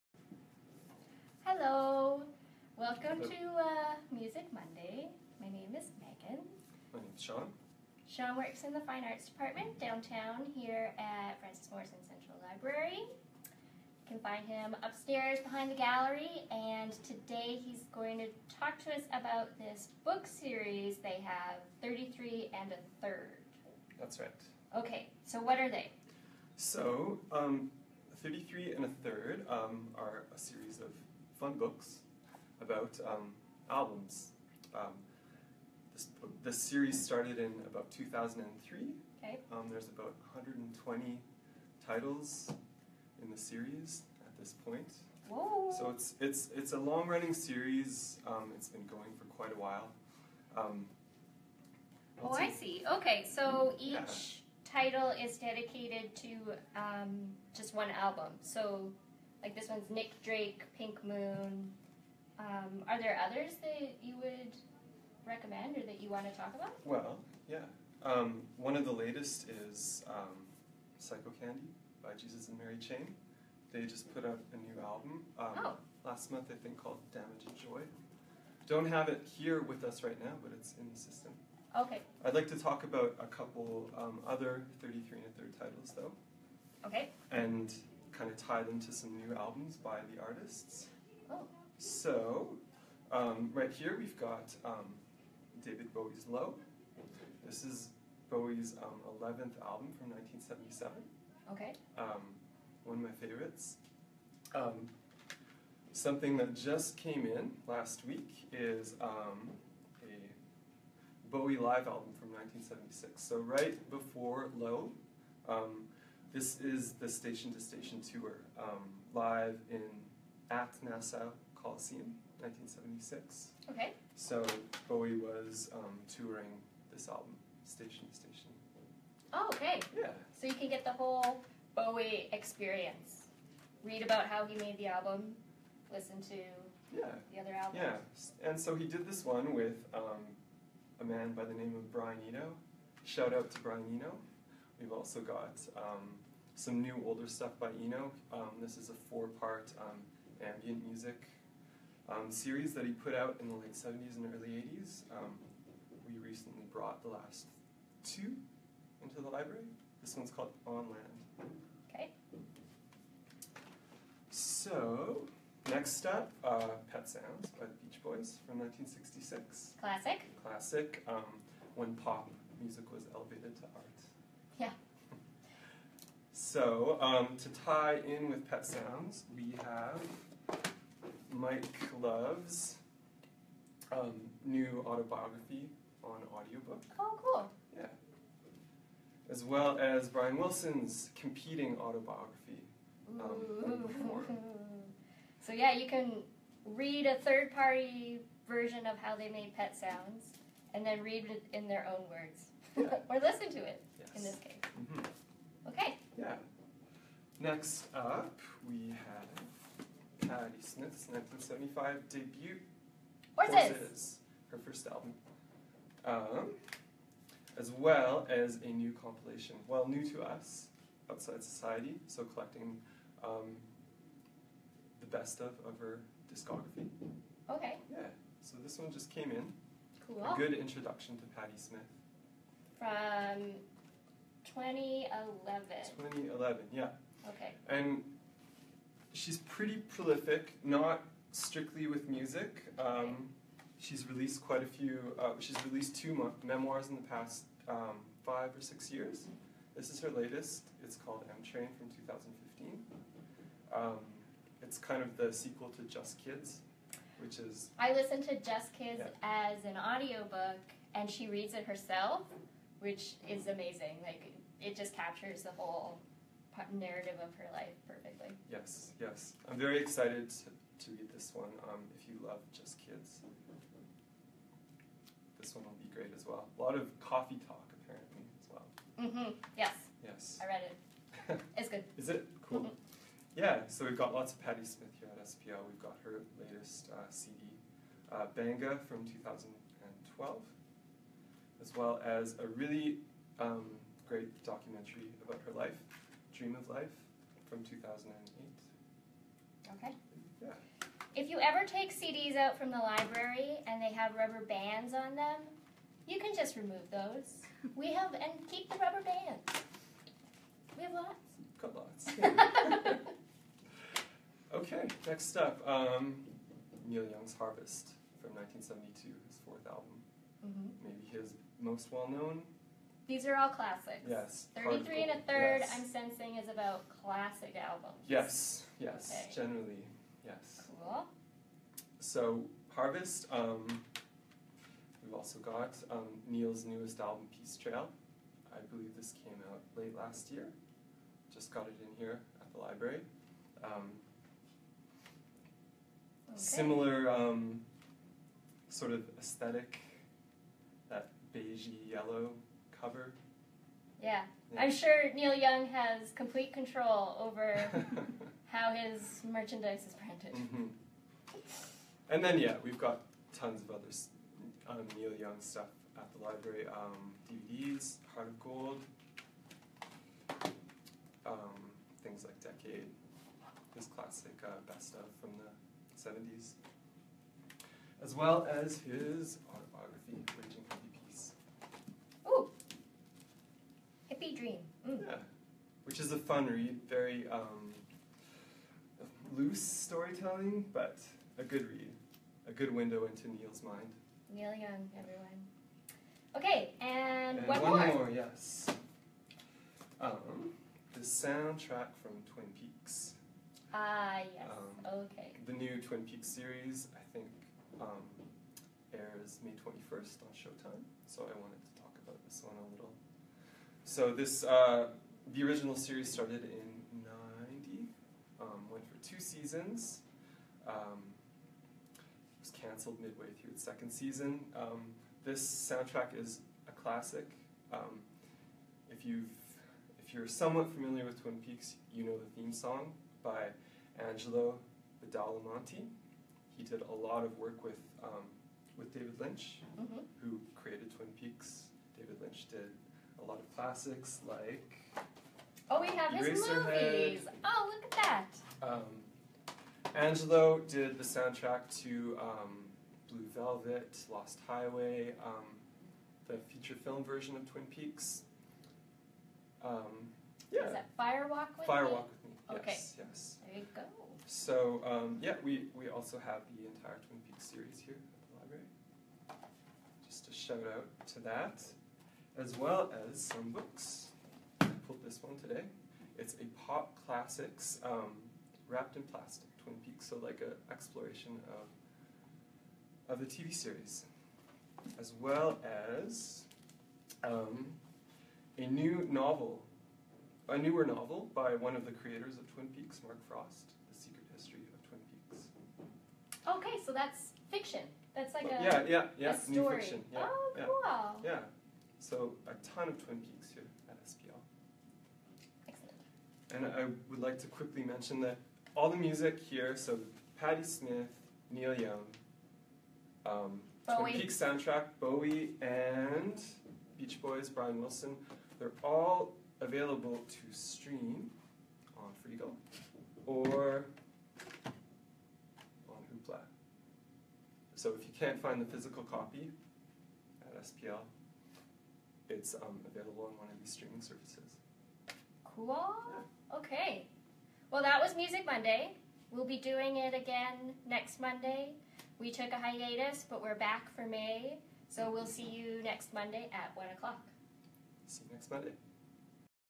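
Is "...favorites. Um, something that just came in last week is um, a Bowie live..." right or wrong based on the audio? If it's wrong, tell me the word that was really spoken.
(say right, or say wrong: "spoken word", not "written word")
right.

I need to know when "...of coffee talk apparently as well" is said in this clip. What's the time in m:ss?
4:36.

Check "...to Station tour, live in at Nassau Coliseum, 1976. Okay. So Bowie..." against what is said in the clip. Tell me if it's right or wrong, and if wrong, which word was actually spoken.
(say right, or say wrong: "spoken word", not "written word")
right.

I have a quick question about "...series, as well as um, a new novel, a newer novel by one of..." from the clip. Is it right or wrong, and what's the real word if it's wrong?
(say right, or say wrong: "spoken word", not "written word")
right.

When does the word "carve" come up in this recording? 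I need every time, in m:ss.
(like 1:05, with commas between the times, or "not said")
not said.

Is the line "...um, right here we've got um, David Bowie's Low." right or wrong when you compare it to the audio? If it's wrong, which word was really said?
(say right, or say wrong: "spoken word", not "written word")
right.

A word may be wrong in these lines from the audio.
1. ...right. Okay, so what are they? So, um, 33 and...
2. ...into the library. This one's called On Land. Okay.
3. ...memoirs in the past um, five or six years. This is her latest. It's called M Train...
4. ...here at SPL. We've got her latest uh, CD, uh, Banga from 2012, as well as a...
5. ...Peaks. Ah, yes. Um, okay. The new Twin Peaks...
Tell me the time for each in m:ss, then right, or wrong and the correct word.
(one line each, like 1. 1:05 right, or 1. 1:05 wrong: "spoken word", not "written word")
1. 0:24 right
2. 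2:39 right
3. 4:06 right
4. 4:44 right
5. 6:42 right.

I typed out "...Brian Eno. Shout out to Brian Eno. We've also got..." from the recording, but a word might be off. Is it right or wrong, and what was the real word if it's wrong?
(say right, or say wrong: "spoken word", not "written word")
right.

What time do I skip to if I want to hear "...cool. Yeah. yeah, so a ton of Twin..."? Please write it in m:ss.
8:20.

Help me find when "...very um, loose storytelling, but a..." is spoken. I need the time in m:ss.
6:26.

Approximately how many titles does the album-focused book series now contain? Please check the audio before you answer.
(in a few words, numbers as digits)
120.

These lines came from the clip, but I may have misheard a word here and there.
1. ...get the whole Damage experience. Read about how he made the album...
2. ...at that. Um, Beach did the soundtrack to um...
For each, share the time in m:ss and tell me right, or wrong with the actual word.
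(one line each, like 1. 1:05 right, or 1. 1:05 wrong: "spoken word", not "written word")
1. 2:10 wrong: "Bowie", not "Damage"
2. 7:27 wrong: "Angelo", not "Beach".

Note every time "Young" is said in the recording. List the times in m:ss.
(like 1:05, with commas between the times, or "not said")
5:17, 5:55, 6:05, 6:34, 8:31.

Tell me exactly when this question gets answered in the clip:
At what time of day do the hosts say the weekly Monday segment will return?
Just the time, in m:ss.
9:06.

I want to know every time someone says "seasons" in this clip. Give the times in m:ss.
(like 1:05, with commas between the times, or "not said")
6:59, 7:03.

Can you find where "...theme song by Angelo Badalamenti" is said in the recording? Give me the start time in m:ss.
7:12.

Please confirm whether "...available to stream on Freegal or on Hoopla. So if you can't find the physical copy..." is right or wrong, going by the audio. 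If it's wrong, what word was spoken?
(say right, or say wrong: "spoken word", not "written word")
right.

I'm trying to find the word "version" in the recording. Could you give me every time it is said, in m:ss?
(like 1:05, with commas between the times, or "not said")
3:18, 7:37.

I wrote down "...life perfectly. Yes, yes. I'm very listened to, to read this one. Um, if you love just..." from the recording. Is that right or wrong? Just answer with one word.
wrong.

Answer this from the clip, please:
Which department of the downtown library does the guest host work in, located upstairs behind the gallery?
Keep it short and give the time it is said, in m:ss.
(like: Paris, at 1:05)
Fine Arts Department, at 0:08.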